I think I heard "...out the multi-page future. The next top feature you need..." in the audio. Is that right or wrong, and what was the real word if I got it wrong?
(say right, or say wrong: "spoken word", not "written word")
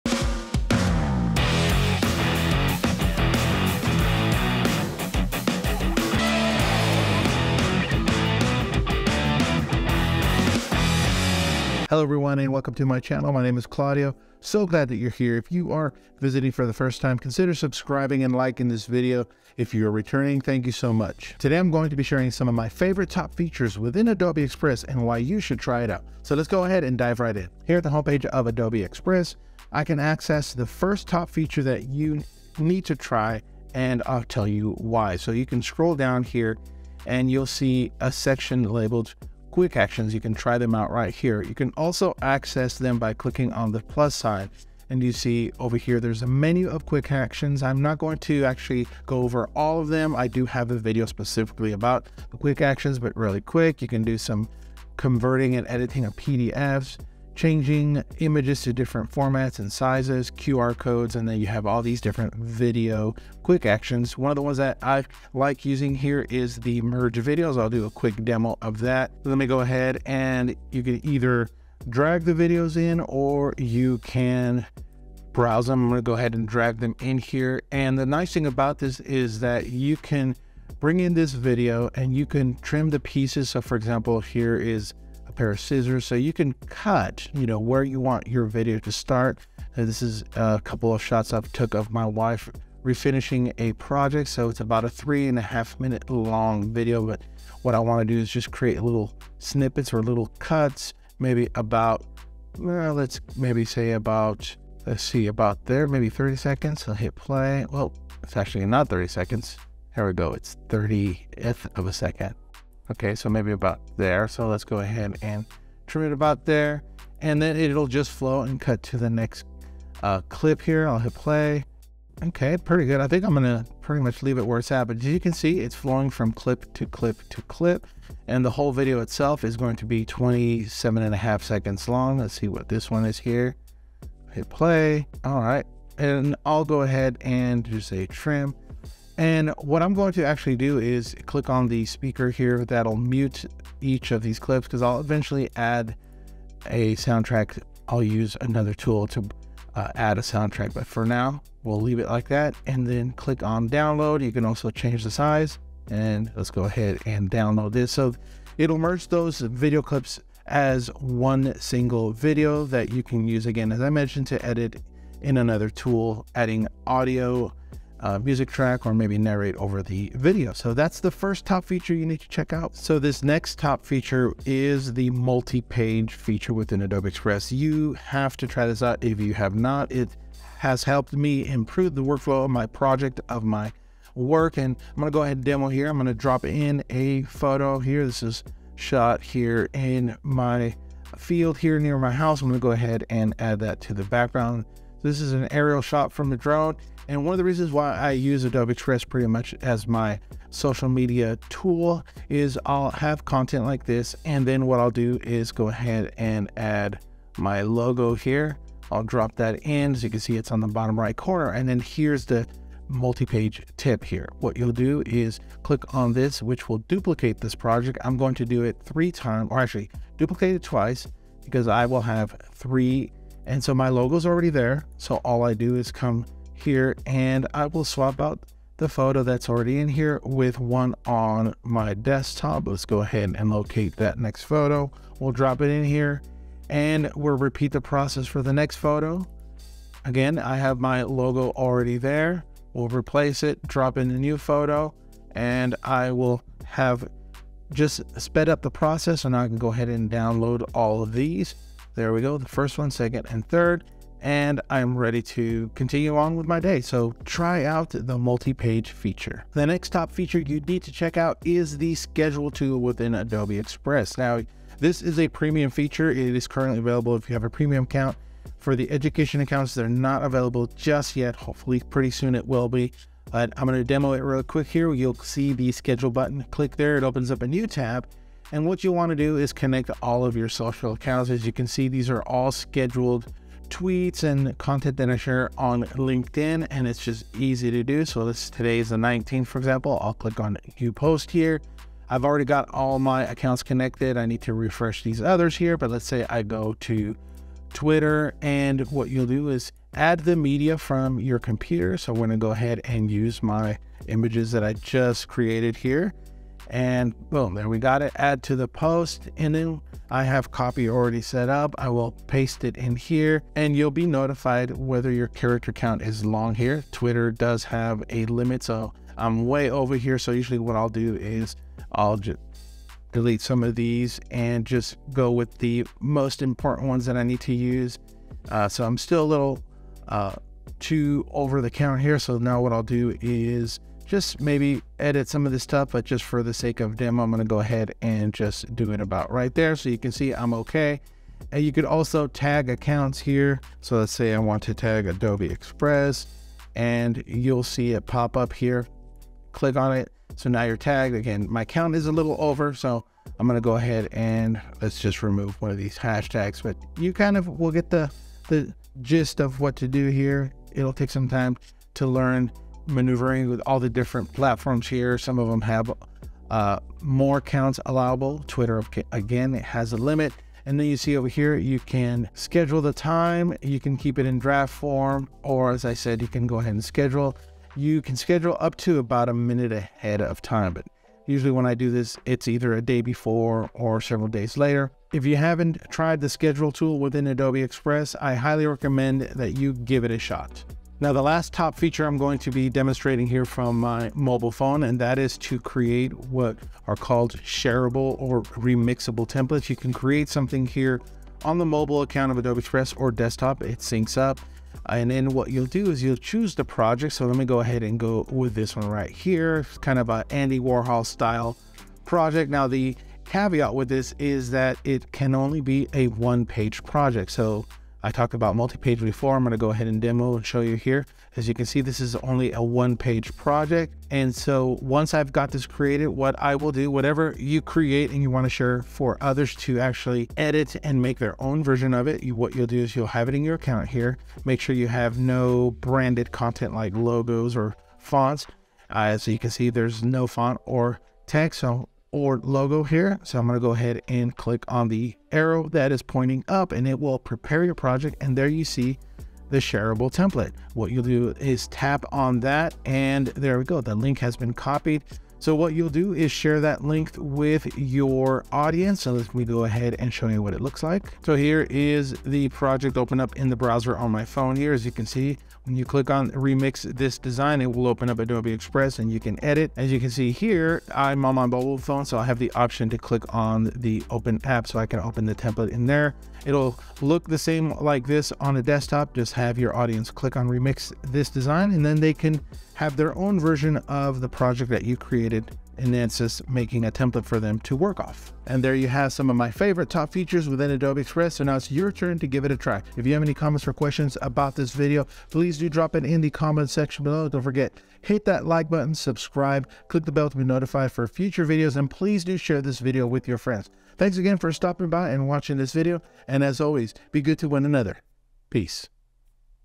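wrong: "feature", not "future".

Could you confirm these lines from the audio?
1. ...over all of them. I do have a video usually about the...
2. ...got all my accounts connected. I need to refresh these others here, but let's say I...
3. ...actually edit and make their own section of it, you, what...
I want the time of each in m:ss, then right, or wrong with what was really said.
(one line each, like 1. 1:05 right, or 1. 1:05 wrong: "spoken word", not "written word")
1. 0:49 wrong: "specifically", not "usually"
2. 4:52 right
3. 7:09 wrong: "version", not "section".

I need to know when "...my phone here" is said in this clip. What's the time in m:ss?
7:44.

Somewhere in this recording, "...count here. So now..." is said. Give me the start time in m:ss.
5:31.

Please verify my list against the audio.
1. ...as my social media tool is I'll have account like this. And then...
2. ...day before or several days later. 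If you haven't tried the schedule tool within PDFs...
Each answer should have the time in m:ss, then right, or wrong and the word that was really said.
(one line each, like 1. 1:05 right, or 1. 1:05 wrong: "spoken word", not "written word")
1. 3:19 wrong: "content", not "account"
2. 6:22 wrong: "Adobe", not "PDFs".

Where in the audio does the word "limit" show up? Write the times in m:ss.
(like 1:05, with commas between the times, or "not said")
5:18, 6:09.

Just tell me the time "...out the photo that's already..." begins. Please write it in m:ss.
3:48.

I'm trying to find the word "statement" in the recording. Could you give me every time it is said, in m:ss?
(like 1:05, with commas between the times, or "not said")
not said.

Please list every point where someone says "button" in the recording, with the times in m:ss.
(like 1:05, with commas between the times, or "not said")
4:36, 8:18.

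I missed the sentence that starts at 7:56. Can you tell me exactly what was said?
It'll look the same like this on a desktop.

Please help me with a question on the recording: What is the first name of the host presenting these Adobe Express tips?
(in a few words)
Claudio.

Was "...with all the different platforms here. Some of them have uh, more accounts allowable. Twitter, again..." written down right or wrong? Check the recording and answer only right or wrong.
right.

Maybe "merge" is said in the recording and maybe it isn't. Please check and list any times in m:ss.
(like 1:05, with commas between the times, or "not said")
1:06, 2:38.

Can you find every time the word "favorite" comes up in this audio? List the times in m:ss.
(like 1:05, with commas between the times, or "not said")
0:22, 8:09.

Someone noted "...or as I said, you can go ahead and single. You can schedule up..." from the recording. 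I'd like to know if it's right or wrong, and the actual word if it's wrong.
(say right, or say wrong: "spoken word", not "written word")
wrong: "schedule", not "single".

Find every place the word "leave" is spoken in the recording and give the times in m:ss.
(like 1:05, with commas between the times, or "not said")
2:04, 2:31.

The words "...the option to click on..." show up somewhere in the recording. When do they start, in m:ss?
7:52.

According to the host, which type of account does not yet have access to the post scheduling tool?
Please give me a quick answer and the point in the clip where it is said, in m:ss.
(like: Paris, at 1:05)
Education accounts, at 4:28.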